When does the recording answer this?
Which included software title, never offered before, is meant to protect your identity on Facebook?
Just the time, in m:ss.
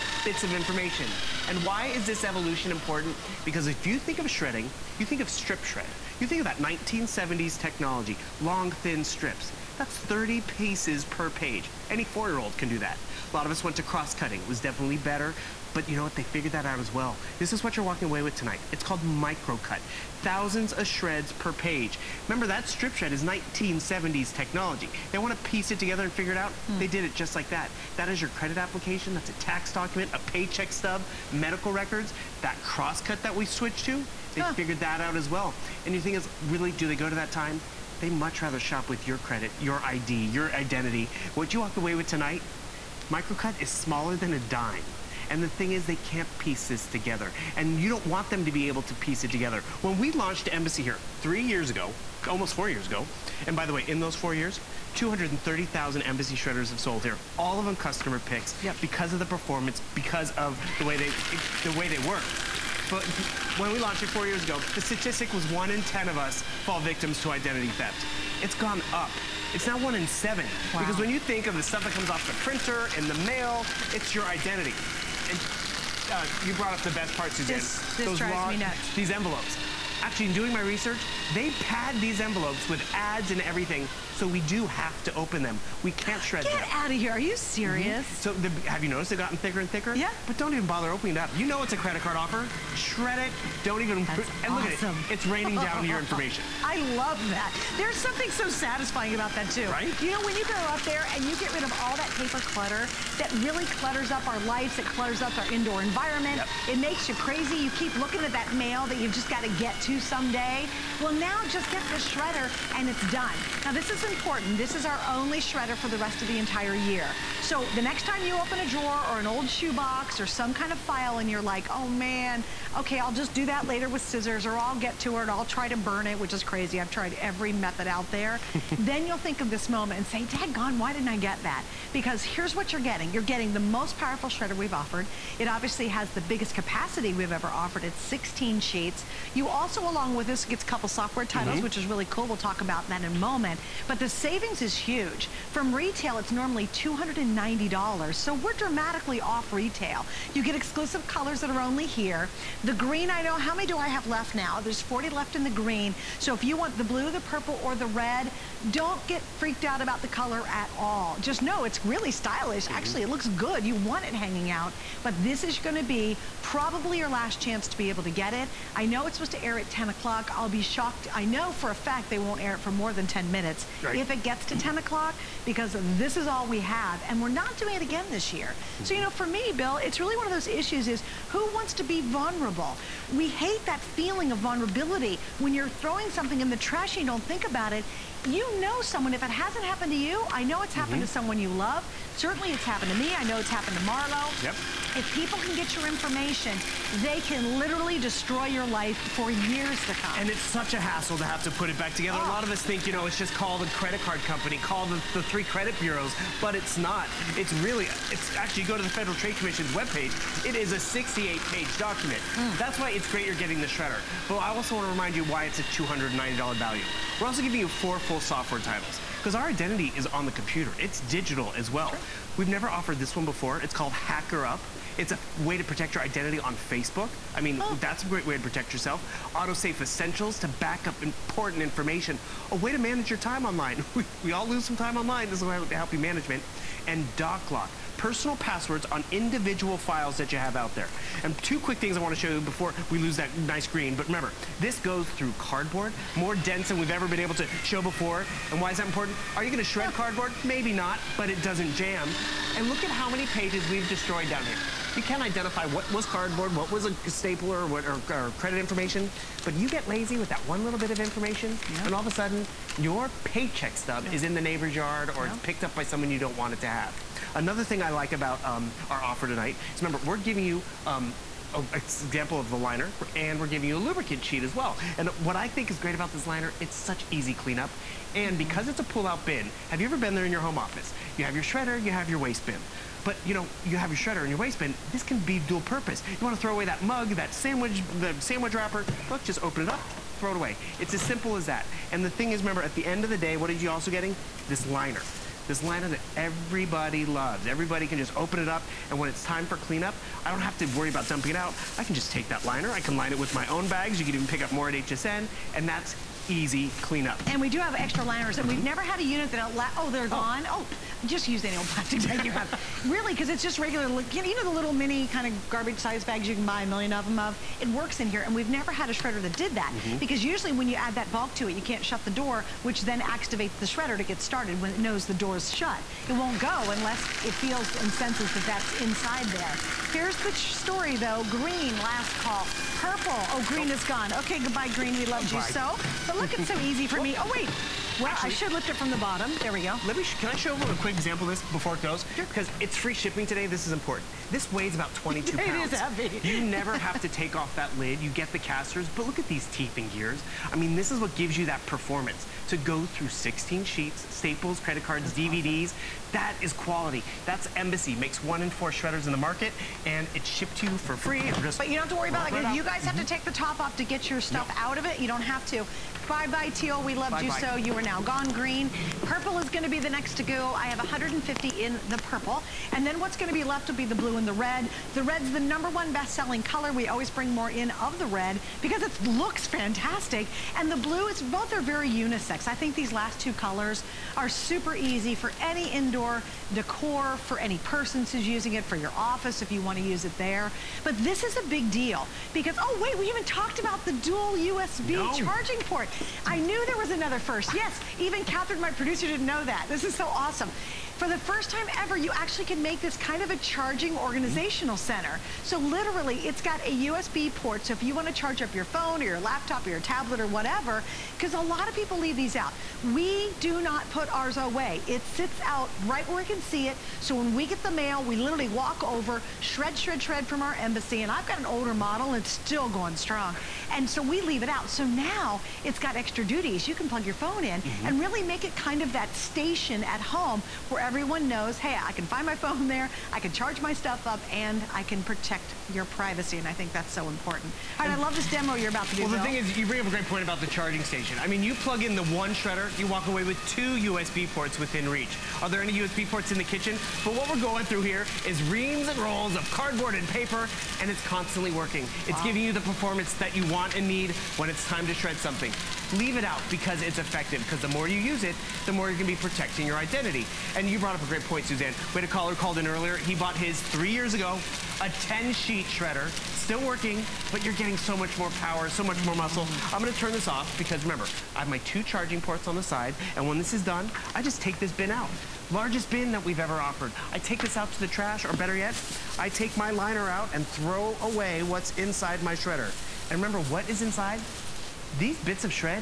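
3:43.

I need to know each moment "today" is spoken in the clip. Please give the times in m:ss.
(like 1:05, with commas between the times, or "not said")
5:43.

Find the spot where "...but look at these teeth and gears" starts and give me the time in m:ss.
5:48.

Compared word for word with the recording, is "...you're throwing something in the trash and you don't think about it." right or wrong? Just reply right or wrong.
right.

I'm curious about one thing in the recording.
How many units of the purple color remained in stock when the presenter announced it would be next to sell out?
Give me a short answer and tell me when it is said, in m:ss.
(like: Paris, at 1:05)
150, at 6:10.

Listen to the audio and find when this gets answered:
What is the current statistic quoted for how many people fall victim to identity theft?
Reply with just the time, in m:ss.
1:09.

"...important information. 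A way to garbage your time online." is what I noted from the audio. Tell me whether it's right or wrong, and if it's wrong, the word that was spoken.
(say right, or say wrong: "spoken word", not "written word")
wrong: "manage", not "garbage".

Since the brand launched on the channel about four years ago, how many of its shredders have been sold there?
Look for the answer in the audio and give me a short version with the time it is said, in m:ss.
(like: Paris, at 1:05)
230,000, at 0:54.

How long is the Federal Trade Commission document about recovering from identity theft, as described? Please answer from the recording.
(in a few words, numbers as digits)
68 pages.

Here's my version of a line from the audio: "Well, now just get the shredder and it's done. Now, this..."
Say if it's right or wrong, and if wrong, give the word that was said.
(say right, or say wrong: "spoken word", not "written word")
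right.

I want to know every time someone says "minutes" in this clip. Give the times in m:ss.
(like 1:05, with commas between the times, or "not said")
2:53.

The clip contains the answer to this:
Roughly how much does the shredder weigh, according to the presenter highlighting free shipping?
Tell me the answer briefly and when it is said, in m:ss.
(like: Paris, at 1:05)
22 pounds, at 5:44.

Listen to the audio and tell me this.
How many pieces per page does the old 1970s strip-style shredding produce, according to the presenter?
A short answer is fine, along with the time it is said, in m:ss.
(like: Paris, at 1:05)
30, at 0:09.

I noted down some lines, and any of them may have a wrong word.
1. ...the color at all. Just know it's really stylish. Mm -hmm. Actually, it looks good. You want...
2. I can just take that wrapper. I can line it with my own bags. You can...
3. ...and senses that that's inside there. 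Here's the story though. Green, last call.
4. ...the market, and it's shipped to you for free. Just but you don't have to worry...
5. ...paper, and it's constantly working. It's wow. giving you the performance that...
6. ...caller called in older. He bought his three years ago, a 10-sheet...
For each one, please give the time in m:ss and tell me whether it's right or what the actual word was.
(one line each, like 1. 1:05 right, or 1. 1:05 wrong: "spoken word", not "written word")
1. 2:40 right
2. 5:01 wrong: "liner", not "wrapper"
3. 5:27 right
4. 5:59 right
5. 7:30 right
6. 7:42 wrong: "earlier", not "older".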